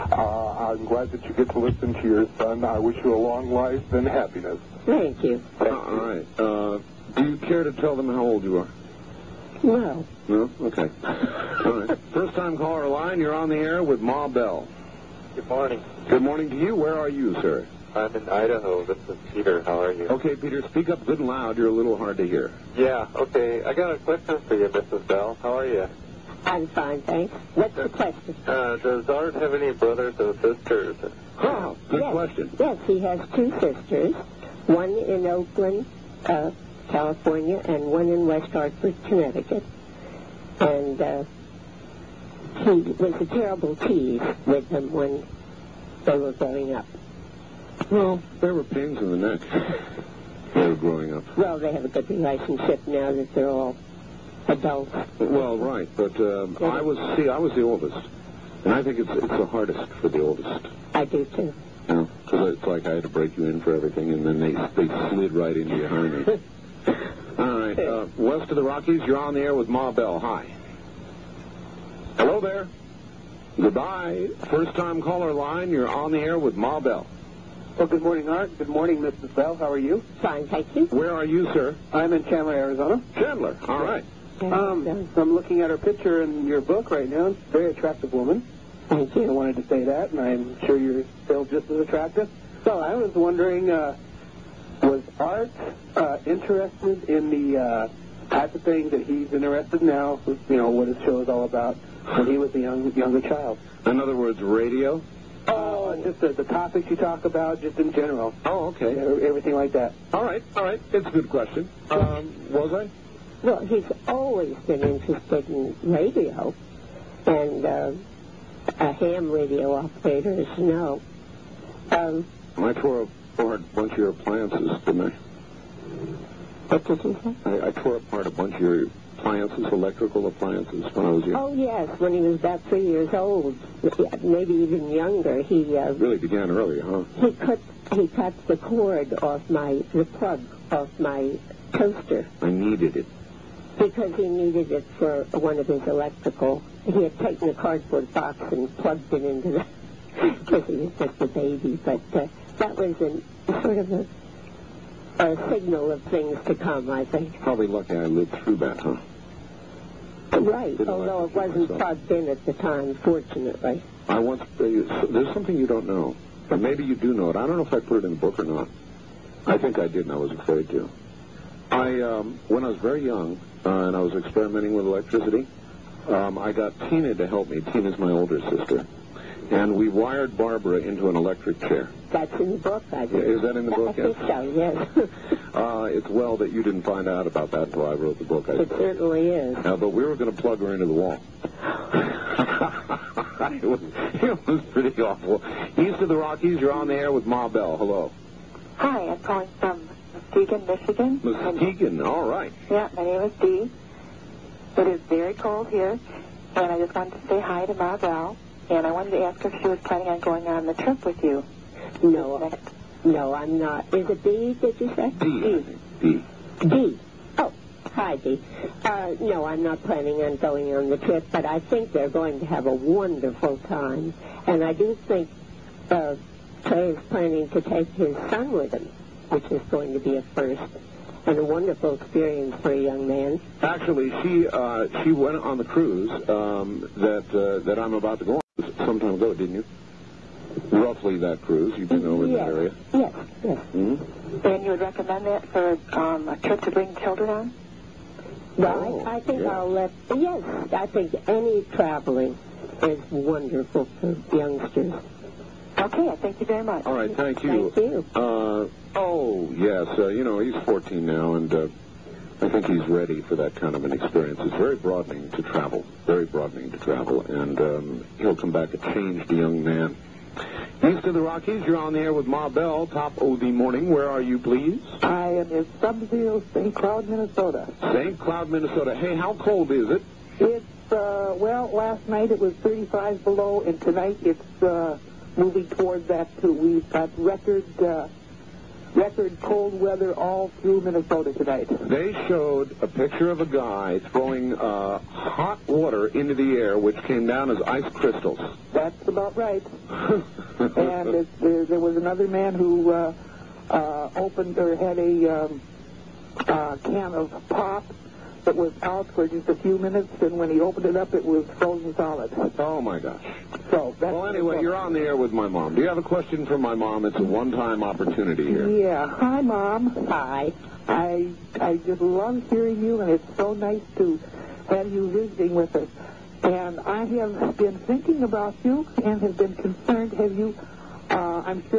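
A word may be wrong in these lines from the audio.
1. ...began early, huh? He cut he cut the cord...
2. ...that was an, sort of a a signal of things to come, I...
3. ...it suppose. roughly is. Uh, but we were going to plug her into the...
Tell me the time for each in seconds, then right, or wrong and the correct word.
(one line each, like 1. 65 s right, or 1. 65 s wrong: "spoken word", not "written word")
1. 136 s right
2. 152 s right
3. 188 s wrong: "certainly", not "roughly".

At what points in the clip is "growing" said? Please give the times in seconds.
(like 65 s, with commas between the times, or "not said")
46 s, 50 s.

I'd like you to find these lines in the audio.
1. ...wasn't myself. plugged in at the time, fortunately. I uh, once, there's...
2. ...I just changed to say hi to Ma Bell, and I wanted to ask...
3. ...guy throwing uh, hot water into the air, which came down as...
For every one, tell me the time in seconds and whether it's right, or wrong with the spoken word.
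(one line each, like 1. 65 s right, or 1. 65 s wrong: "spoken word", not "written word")
1. 161 s right
2. 206 s wrong: "wanted", not "changed"
3. 293 s right.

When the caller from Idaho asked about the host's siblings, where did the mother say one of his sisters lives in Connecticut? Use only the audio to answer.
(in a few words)
West Hartford.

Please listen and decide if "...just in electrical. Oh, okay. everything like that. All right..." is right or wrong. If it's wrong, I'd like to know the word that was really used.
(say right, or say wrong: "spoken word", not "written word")
wrong: "general", not "electrical".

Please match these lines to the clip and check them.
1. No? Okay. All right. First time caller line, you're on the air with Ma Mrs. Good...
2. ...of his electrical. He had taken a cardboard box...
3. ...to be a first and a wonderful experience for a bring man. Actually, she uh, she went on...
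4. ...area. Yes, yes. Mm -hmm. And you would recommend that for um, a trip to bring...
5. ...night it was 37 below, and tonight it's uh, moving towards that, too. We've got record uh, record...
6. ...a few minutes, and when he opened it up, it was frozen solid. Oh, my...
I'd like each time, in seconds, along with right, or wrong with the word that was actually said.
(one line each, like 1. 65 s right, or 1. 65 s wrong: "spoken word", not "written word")
1. 10 s wrong: "Bell", not "Mrs"
2. 145 s right
3. 229 s wrong: "young", not "bring"
4. 242 s right
5. 282 s wrong: "35", not "37"
6. 309 s right.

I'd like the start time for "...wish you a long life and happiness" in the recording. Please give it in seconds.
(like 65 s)
2 s.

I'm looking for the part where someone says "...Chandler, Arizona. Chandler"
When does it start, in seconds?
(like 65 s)
82 s.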